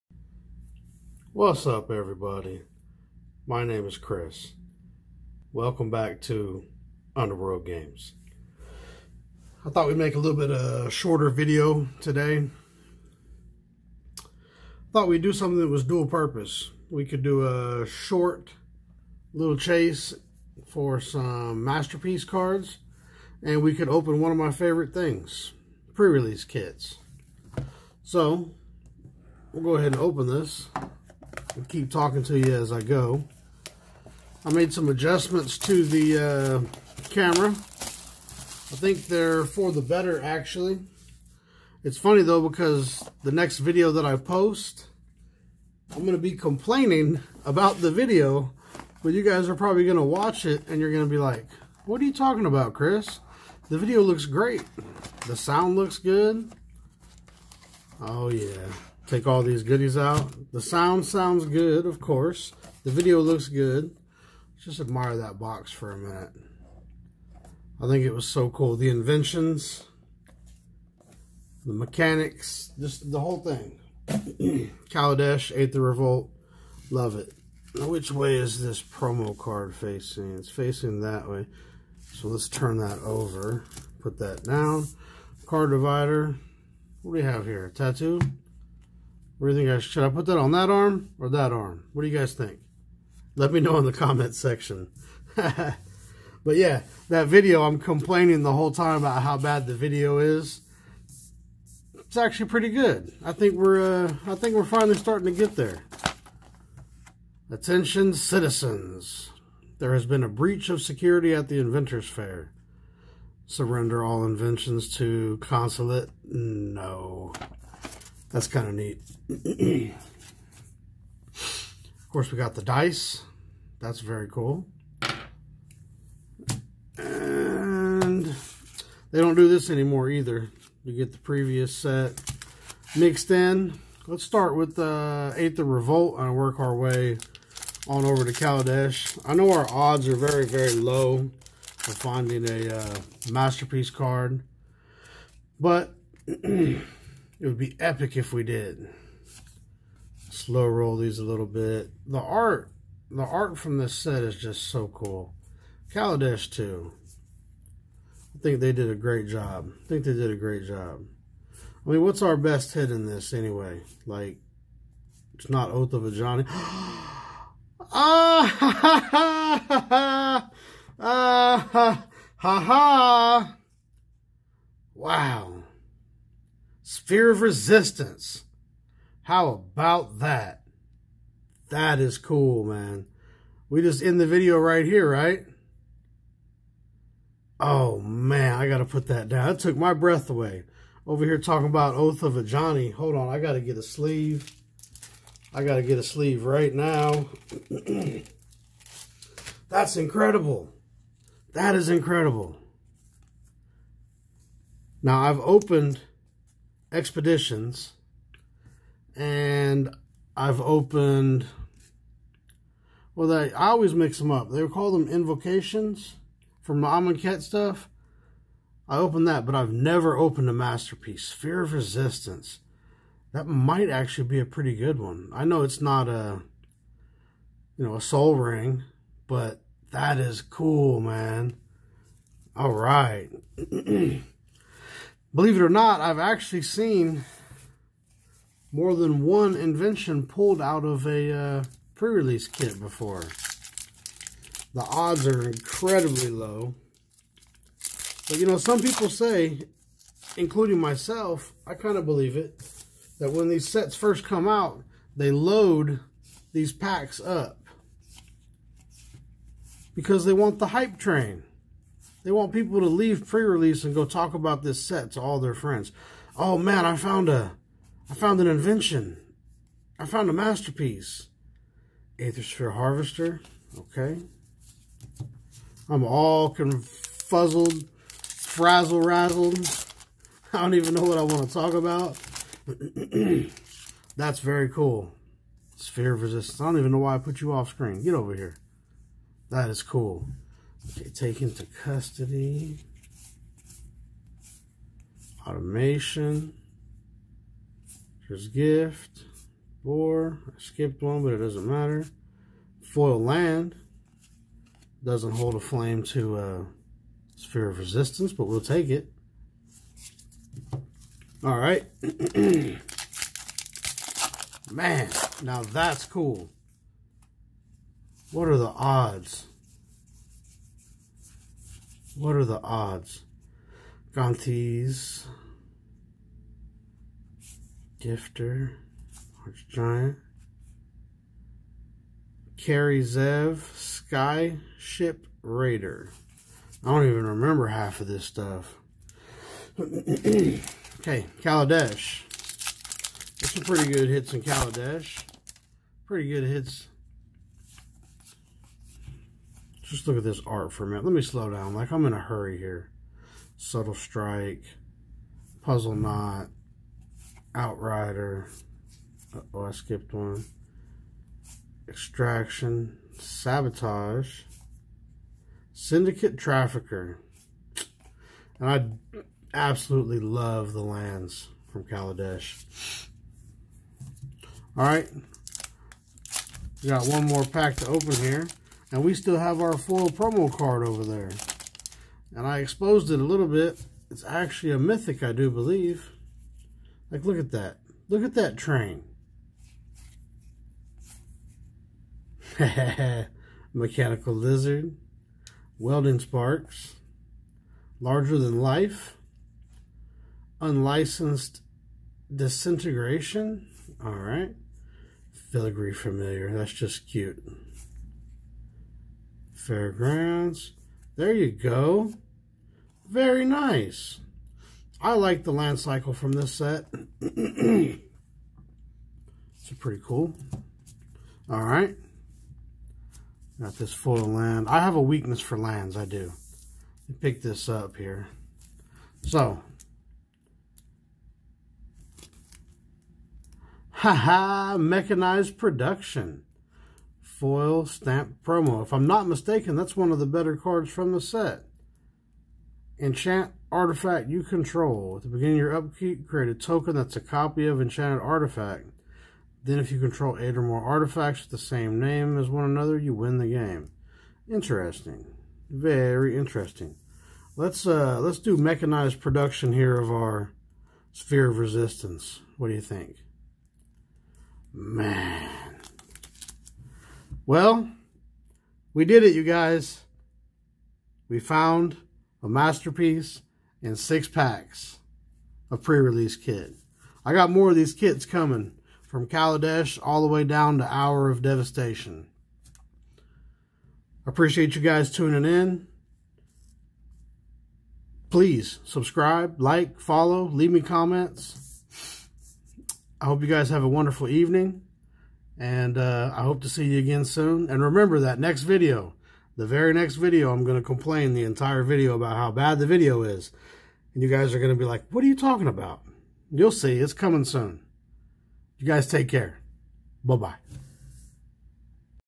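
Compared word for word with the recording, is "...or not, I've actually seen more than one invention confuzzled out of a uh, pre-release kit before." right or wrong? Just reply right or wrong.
wrong.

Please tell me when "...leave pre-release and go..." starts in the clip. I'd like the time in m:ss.
4:22.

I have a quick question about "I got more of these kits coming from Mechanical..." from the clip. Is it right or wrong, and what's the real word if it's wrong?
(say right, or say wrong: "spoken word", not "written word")
wrong: "Kaladesh", not "Mechanical".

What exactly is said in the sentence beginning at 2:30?
Slow roll these a little bit.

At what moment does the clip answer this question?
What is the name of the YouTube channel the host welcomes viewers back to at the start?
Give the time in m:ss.
0:07.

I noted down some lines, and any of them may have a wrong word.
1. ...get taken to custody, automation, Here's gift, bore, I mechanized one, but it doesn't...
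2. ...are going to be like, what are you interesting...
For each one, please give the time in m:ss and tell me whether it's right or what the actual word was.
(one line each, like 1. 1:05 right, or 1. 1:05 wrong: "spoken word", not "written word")
1. 4:50 wrong: "skipped", not "mechanized"
2. 8:24 wrong: "talking", not "interesting".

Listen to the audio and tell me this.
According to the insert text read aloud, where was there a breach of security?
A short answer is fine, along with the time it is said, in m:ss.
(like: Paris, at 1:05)
Inventors Fair, at 1:51.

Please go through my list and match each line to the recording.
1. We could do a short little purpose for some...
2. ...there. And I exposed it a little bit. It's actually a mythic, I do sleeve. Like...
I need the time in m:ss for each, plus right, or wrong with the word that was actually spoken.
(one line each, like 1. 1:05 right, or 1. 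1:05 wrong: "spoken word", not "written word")
1. 0:16 wrong: "chase", not "purpose"
2. 6:21 wrong: "believe", not "sleeve".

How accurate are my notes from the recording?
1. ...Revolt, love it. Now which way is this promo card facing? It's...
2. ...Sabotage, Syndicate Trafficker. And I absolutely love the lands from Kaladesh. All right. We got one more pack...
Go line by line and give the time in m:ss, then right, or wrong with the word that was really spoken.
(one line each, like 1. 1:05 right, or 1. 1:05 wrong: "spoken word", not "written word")
1. 1:15 right
2. 6:03 right.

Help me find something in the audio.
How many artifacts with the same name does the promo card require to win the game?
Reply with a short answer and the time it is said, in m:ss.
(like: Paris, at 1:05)
8, at 7:30.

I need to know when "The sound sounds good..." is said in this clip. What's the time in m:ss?
1:00.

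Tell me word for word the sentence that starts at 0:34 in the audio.
I made some adjustments to the uh, camera.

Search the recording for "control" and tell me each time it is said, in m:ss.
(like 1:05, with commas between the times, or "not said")
7:24, 7:29.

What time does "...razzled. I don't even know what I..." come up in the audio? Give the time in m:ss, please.
4:39.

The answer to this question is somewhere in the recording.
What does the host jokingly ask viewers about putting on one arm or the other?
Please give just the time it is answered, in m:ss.
1:27.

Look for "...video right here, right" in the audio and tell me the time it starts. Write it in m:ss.
3:04.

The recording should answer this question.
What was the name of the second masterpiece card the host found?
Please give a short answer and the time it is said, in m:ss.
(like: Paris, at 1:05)
Aethersphere Harvester, at 4:32.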